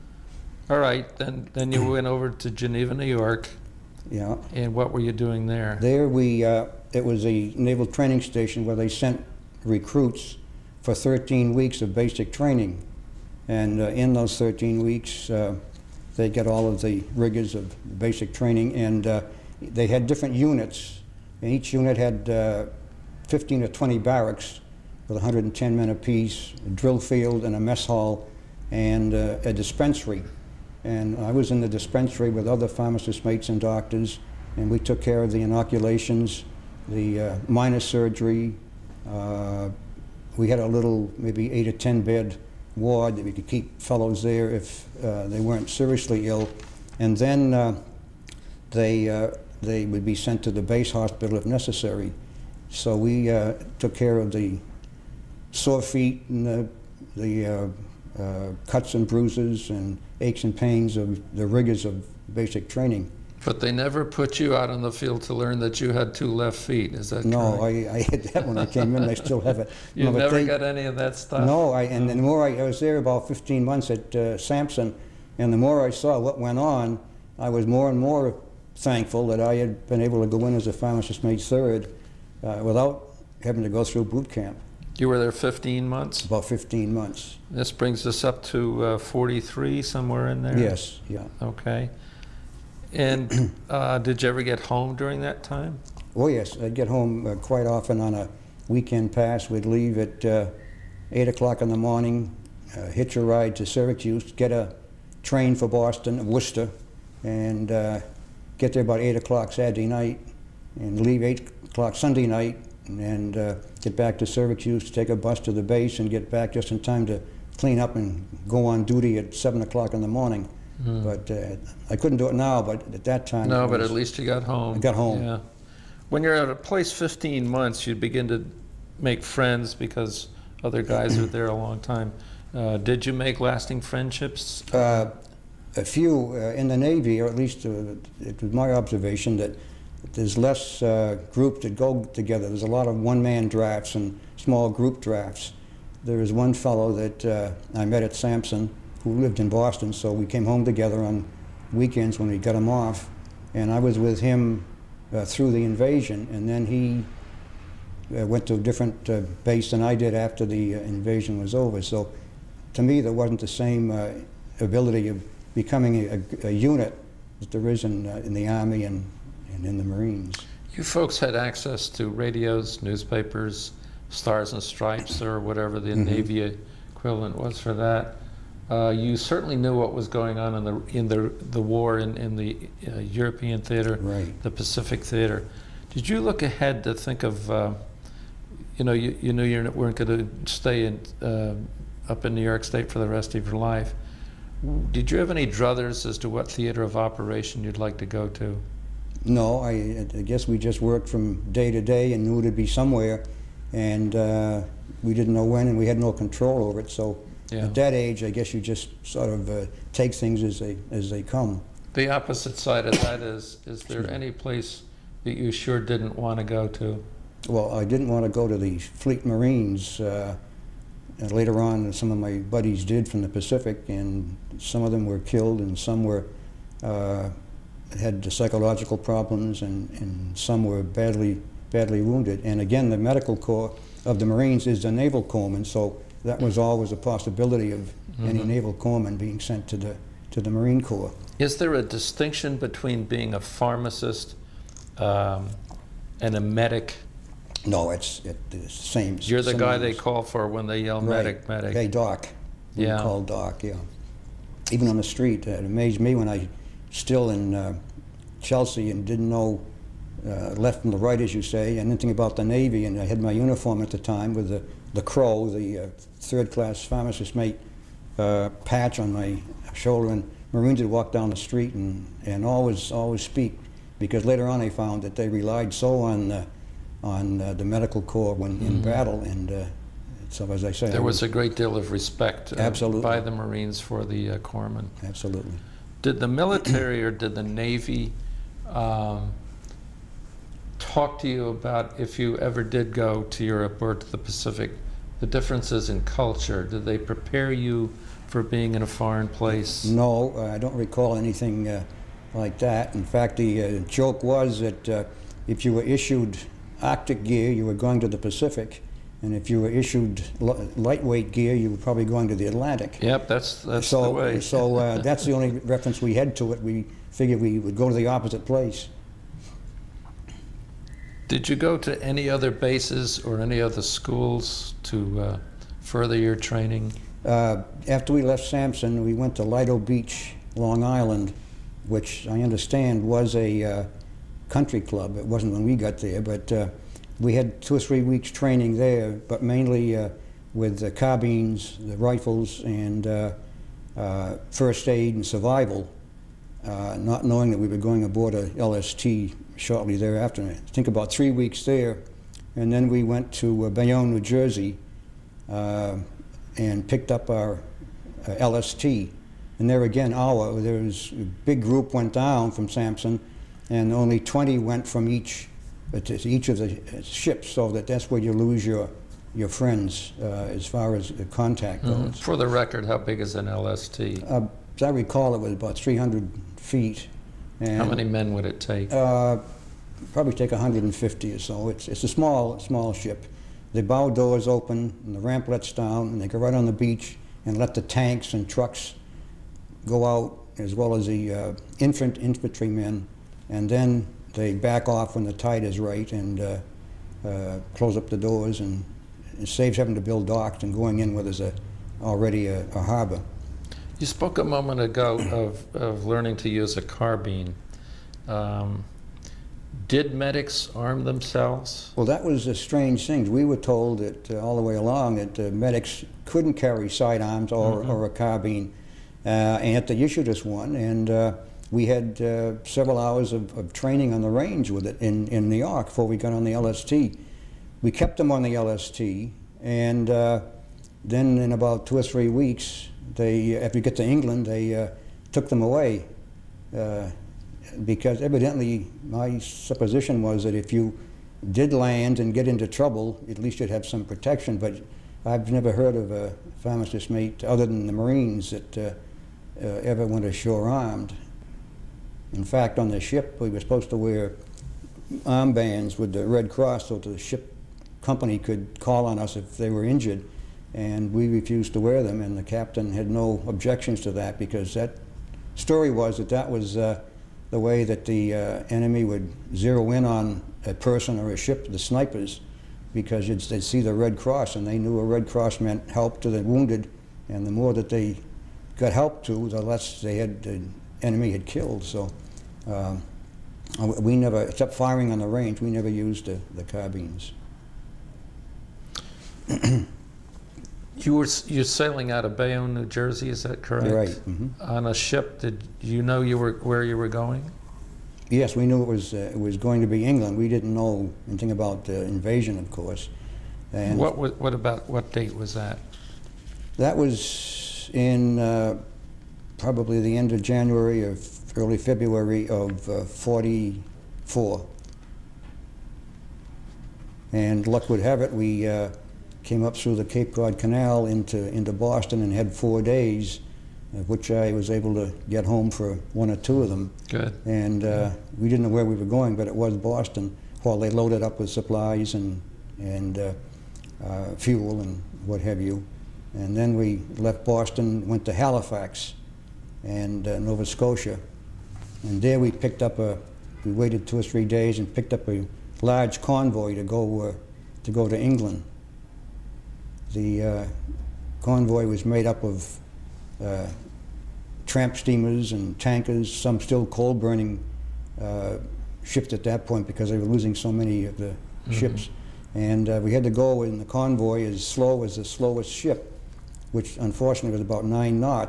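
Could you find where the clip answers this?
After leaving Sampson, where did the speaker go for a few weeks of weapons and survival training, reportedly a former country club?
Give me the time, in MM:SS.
05:29.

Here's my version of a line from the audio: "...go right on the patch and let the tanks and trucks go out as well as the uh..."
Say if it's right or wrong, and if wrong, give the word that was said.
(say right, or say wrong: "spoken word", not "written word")
wrong: "beach", not "patch".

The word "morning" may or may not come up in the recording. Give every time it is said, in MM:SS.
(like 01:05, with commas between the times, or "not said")
01:41, 02:00.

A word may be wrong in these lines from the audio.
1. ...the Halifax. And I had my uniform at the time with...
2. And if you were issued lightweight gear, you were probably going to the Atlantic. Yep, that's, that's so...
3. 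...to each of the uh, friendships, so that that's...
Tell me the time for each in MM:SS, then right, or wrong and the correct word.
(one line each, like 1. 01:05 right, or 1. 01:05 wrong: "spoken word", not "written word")
1. 04:22 wrong: "Navy", not "Halifax"
2. 05:09 right
3. 06:05 wrong: "ships", not "friendships".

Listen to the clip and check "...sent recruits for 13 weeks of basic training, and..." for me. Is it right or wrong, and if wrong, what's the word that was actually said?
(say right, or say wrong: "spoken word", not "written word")
right.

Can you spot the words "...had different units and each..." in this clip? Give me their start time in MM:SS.
00:19.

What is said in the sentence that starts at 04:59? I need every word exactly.
No, uh, I don't recall anything uh, like that.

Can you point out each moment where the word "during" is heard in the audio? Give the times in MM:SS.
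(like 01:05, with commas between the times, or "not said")
01:34.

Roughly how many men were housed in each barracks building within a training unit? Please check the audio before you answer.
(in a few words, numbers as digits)
110.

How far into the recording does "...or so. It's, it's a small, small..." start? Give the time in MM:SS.
06:21.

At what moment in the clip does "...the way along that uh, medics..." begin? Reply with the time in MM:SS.
06:54.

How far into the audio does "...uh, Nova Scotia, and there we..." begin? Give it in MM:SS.
09:00.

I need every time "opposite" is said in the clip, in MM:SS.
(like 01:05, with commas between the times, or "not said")
03:32, 05:18.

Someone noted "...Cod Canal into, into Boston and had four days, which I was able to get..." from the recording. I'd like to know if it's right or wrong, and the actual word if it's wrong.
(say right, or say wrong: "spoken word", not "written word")
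right.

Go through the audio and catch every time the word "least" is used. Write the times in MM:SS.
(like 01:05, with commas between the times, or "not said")
02:03, 02:17, 07:23.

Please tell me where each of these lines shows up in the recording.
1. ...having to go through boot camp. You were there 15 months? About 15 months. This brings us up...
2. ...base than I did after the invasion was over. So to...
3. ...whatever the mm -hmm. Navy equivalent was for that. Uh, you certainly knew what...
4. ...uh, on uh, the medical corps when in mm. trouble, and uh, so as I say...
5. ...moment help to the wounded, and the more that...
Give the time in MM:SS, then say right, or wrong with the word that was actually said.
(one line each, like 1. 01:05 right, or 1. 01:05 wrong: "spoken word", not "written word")
1. 01:23 right
2. 02:39 right
3. 02:55 right
4. 04:36 wrong: "battle", not "trouble"
5. 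07:55 wrong: "meant", not "moment".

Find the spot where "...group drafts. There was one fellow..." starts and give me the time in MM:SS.
02:24.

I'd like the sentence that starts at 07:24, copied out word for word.
But I've never heard of a pharmacist mate other than the Marines that uh, uh, ever went ashore armed.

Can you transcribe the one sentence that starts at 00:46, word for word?
And then uh, they uh, they would be sent to the base hospital if necessary.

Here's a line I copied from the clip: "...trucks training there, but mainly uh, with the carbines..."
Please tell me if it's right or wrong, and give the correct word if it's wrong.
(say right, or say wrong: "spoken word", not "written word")
wrong: "weeks", not "trucks".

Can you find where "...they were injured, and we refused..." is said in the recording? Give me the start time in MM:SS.
07:39.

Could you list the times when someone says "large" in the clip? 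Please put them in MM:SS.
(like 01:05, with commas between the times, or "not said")
09:05.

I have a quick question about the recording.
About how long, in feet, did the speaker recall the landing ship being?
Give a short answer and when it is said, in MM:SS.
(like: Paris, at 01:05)
300 feet, at 06:15.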